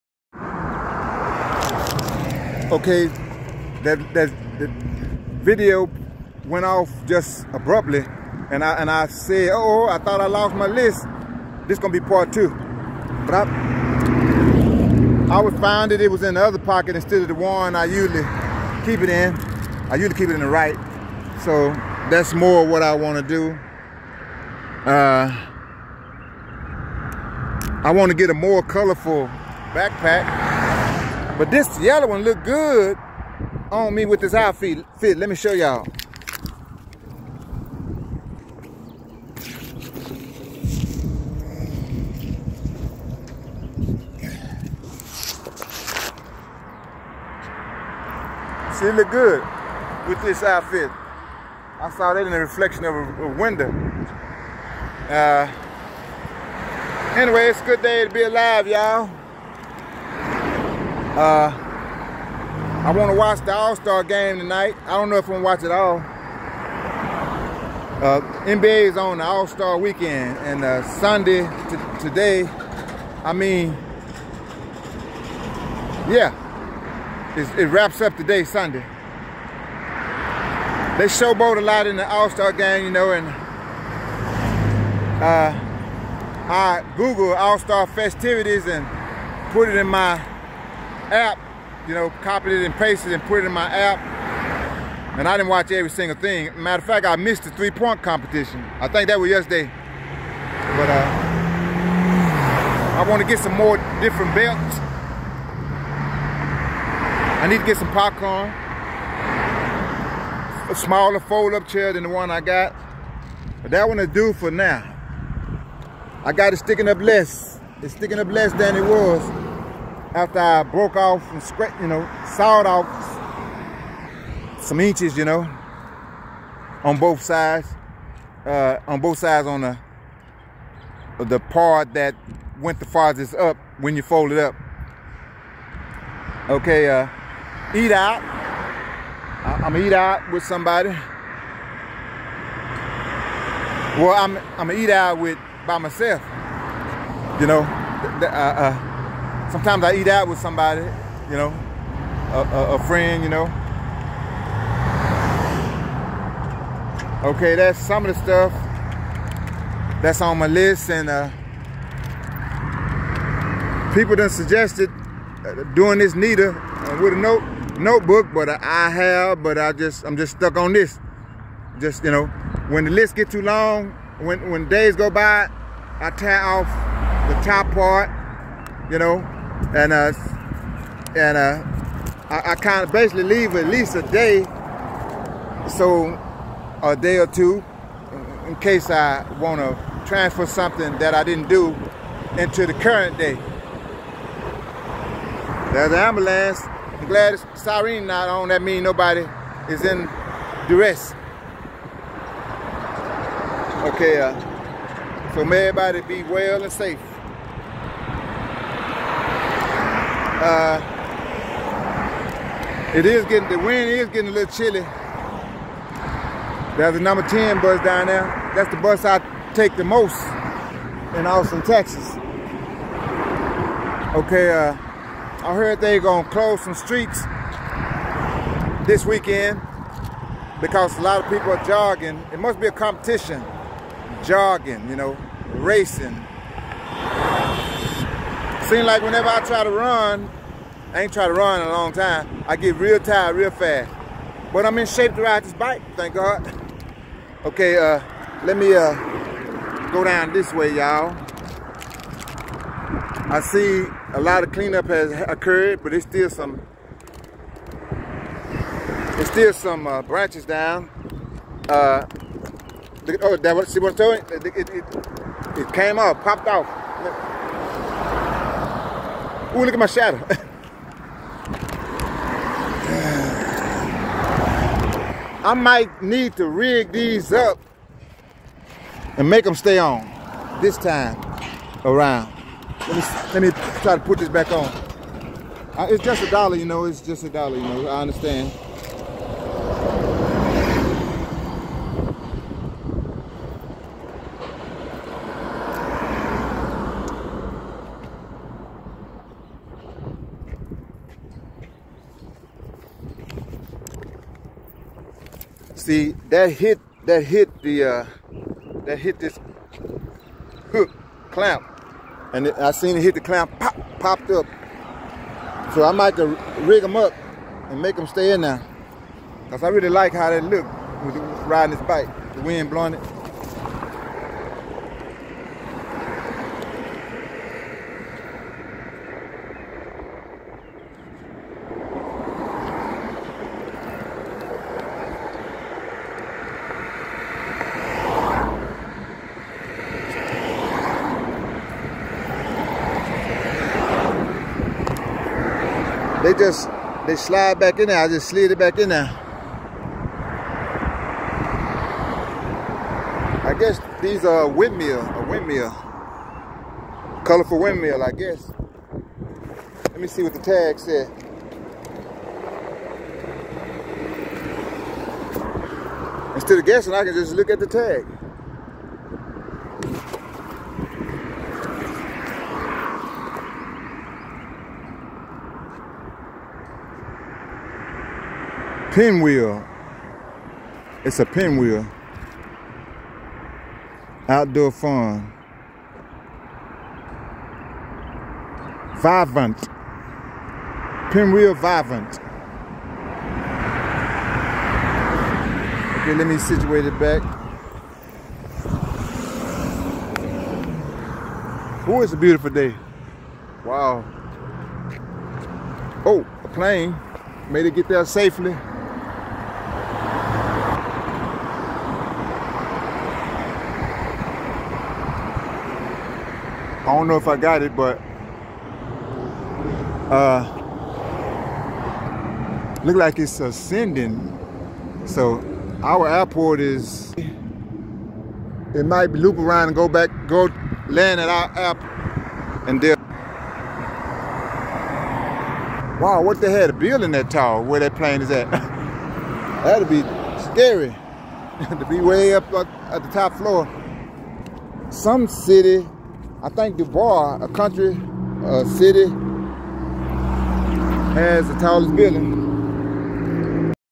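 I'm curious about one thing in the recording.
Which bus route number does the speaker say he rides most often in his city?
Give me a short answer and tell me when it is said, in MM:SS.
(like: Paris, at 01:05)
10, at 03:36.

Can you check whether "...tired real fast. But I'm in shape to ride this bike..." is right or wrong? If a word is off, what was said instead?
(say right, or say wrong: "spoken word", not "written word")
right.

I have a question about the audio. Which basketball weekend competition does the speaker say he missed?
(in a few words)
three-point competition.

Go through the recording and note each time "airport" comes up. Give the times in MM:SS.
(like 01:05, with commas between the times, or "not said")
07:06, 07:11.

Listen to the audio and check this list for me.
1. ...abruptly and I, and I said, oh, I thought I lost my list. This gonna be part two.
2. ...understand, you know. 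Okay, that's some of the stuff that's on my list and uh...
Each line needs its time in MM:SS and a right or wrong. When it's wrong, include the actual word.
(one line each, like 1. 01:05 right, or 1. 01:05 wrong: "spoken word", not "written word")
1. 00:07 right
2. 02:32 wrong: "friend", not "understand".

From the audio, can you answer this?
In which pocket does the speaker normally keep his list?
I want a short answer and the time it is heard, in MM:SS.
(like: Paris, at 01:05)
the right, at 00:20.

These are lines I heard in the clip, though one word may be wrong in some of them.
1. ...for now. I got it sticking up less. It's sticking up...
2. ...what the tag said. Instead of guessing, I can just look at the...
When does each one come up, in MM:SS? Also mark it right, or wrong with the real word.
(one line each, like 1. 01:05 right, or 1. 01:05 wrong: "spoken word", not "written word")
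1. 01:54 right
2. 06:00 right.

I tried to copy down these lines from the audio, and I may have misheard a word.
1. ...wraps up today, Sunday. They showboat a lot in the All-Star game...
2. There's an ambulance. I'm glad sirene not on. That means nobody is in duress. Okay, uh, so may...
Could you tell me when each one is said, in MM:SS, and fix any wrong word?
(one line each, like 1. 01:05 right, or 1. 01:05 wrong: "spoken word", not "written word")
1. 01:17 right
2. 03:15 right.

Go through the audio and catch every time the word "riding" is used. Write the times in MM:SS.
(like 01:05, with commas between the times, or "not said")
05:21.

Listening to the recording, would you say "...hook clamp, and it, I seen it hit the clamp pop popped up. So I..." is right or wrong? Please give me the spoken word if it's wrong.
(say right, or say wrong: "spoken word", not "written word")
right.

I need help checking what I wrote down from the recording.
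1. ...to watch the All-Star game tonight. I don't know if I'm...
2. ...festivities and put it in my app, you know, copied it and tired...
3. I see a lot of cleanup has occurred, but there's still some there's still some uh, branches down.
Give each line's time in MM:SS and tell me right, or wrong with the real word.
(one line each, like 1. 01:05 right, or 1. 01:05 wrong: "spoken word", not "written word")
1. 01:03 right
2. 01:27 wrong: "pasted", not "tired"
3. 04:13 right.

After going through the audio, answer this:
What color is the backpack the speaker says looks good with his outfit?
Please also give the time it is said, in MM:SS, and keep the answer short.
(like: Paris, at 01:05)
yellow, at 00:31.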